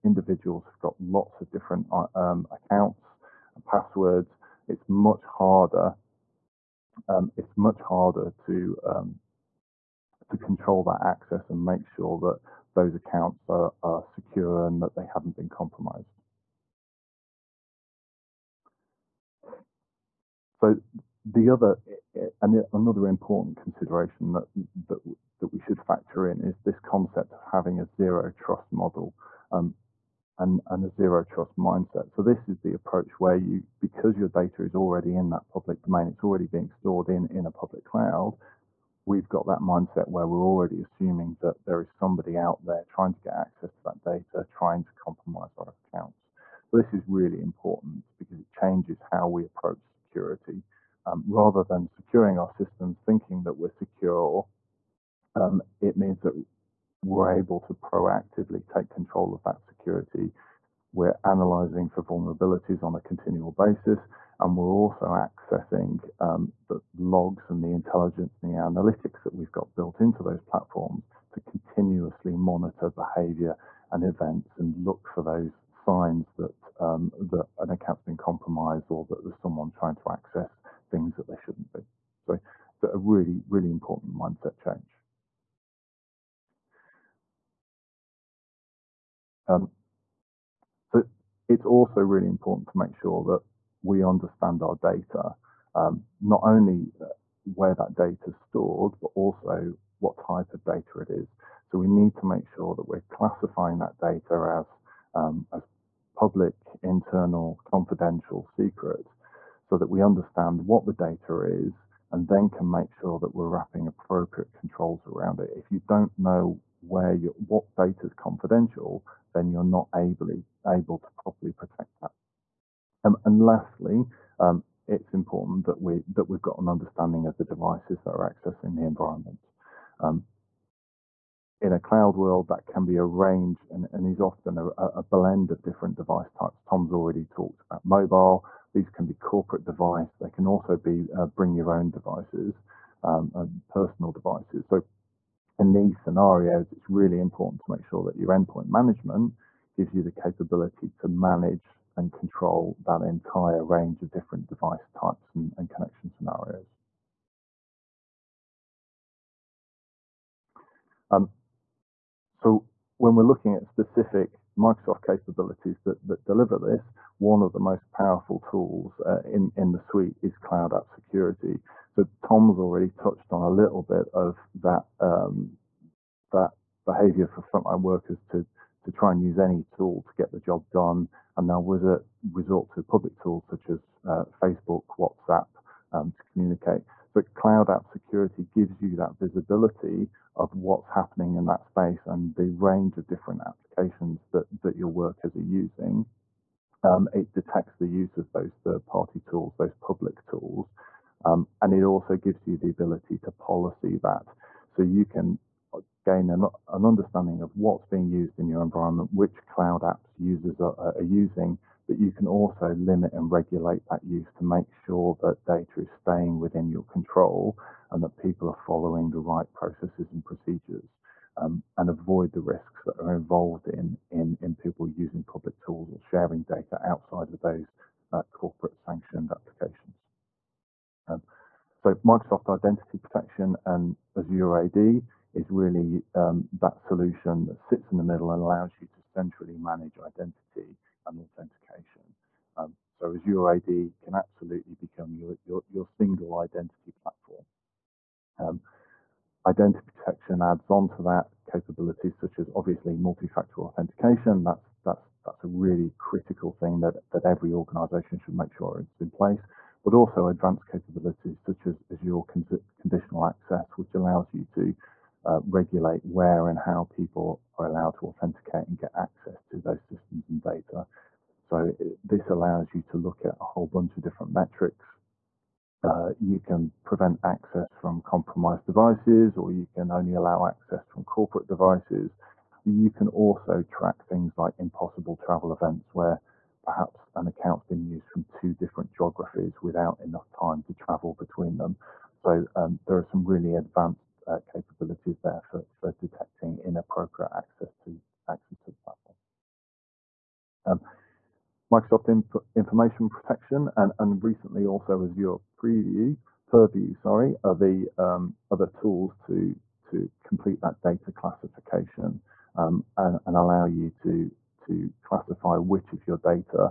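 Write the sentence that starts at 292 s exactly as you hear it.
So um, there are some really advanced uh, capabilities there for, for detecting inappropriate access to access to the platform.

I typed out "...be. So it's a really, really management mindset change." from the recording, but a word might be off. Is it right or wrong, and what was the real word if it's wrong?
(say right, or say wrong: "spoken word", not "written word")
wrong: "important", not "management".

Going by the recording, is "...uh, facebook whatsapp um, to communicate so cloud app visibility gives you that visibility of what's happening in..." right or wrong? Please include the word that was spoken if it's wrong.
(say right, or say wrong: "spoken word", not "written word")
wrong: "security", not "visibility".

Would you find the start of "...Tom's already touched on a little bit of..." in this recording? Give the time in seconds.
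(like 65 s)
172 s.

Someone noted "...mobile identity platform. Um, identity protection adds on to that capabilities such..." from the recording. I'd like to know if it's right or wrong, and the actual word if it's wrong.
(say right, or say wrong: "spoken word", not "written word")
wrong: "single", not "mobile".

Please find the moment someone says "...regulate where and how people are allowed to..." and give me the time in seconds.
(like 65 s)
265 s.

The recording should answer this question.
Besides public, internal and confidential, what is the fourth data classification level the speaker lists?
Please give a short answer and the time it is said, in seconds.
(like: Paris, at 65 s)
secret, at 108 s.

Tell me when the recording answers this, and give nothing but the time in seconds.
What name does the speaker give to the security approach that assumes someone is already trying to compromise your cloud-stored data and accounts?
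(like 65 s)
27 s.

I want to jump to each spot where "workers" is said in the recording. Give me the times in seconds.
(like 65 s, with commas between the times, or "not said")
177 s, 194 s.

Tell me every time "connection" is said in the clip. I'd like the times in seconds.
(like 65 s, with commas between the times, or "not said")
155 s.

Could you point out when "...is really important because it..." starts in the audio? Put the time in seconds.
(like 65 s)
46 s.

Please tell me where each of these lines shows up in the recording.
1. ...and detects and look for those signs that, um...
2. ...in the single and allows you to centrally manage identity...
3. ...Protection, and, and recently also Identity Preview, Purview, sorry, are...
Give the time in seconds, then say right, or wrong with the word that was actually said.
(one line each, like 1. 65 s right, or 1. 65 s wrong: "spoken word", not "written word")
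1. 73 s wrong: "events", not "detects"
2. 237 s wrong: "middle", not "single"
3. 303 s wrong: "Azure", not "Identity".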